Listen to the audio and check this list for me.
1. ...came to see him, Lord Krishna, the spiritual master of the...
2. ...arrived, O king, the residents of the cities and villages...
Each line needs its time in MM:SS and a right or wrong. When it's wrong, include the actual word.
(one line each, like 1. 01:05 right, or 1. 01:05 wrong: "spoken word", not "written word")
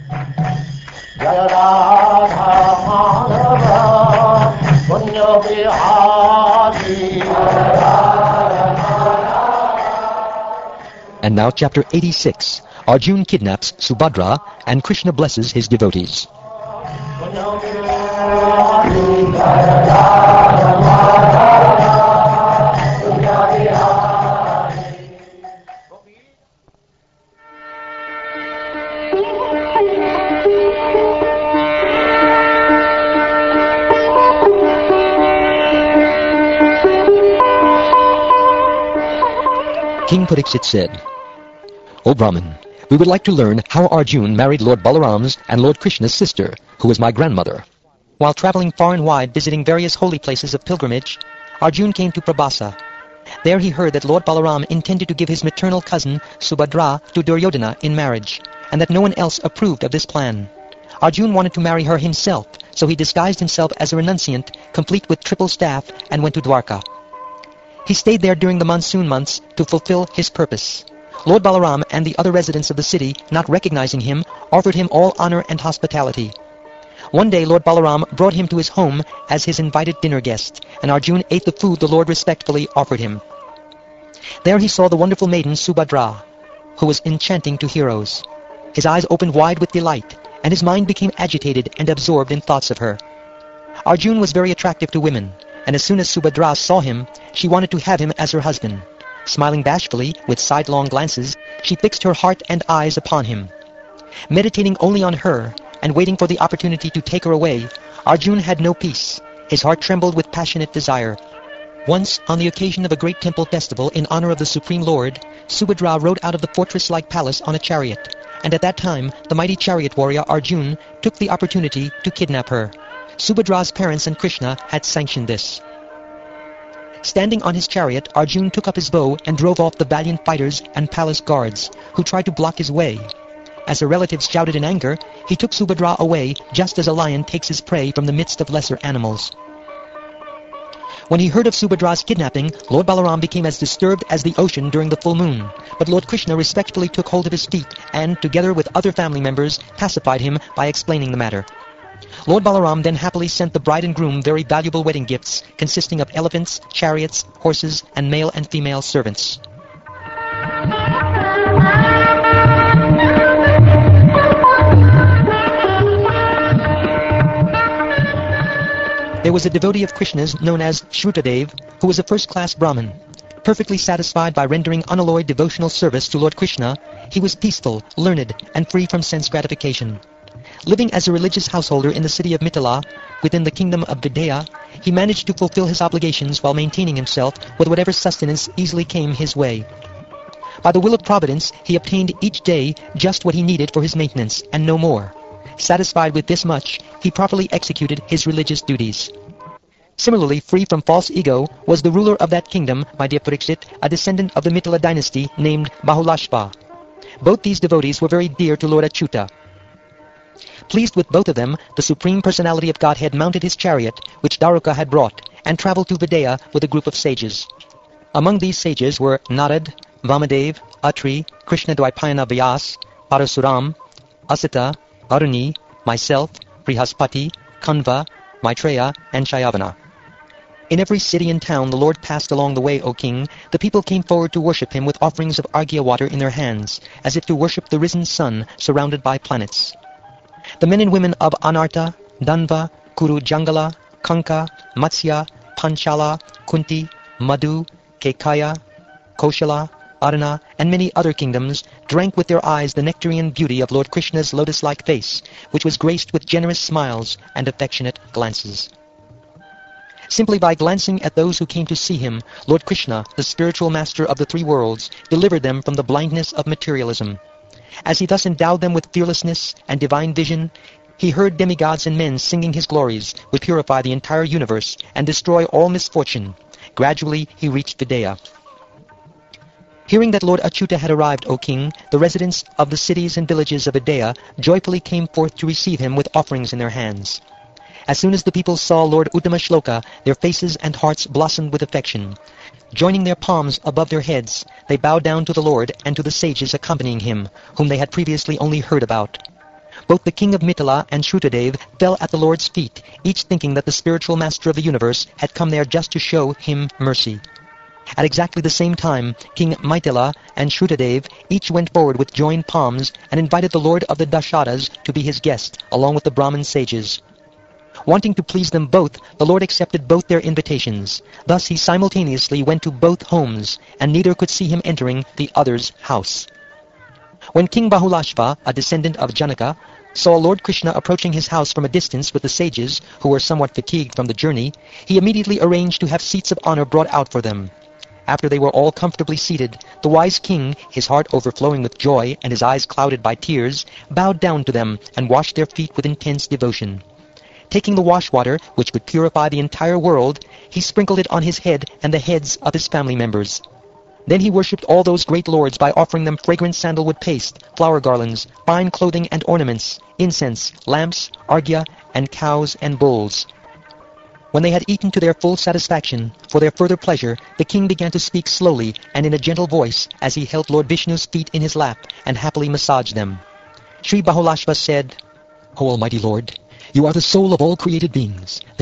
1. 04:21 right
2. 04:40 right.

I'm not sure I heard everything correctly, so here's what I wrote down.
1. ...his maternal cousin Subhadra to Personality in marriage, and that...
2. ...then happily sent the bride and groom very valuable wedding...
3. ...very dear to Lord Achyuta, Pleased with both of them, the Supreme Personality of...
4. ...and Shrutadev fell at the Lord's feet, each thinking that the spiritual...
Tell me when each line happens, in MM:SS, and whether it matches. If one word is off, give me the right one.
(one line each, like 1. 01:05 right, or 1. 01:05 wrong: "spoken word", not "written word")
1. 00:55 wrong: "Duryodhana", not "Personality"
2. 02:32 right
3. 03:28 right
4. 05:00 right.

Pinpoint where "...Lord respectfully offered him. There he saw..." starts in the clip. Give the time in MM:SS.
01:21.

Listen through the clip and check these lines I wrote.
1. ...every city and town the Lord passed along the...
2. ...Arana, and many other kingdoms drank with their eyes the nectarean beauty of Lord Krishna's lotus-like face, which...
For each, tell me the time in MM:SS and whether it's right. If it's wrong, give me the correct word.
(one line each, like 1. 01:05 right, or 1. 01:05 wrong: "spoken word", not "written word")
1. 03:50 right
2. 04:10 right.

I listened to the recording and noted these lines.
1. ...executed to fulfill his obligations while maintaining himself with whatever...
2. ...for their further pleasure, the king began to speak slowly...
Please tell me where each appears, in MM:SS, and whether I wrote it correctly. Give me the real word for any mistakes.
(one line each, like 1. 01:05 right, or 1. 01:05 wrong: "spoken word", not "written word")
1. 03:04 wrong: "managed", not "executed"
2. 06:06 right.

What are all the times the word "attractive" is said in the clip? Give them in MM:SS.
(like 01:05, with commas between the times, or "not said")
01:34.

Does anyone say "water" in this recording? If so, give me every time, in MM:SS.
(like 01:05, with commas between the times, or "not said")
03:55, 05:48.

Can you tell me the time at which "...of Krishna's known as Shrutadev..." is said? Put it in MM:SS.
02:49.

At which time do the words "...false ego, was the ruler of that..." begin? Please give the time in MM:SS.
03:20.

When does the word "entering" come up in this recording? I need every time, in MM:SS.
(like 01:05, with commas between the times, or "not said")
05:24.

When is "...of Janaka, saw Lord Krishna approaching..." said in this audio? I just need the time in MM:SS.
05:28.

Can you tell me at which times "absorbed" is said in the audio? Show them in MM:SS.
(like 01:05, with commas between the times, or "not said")
01:31.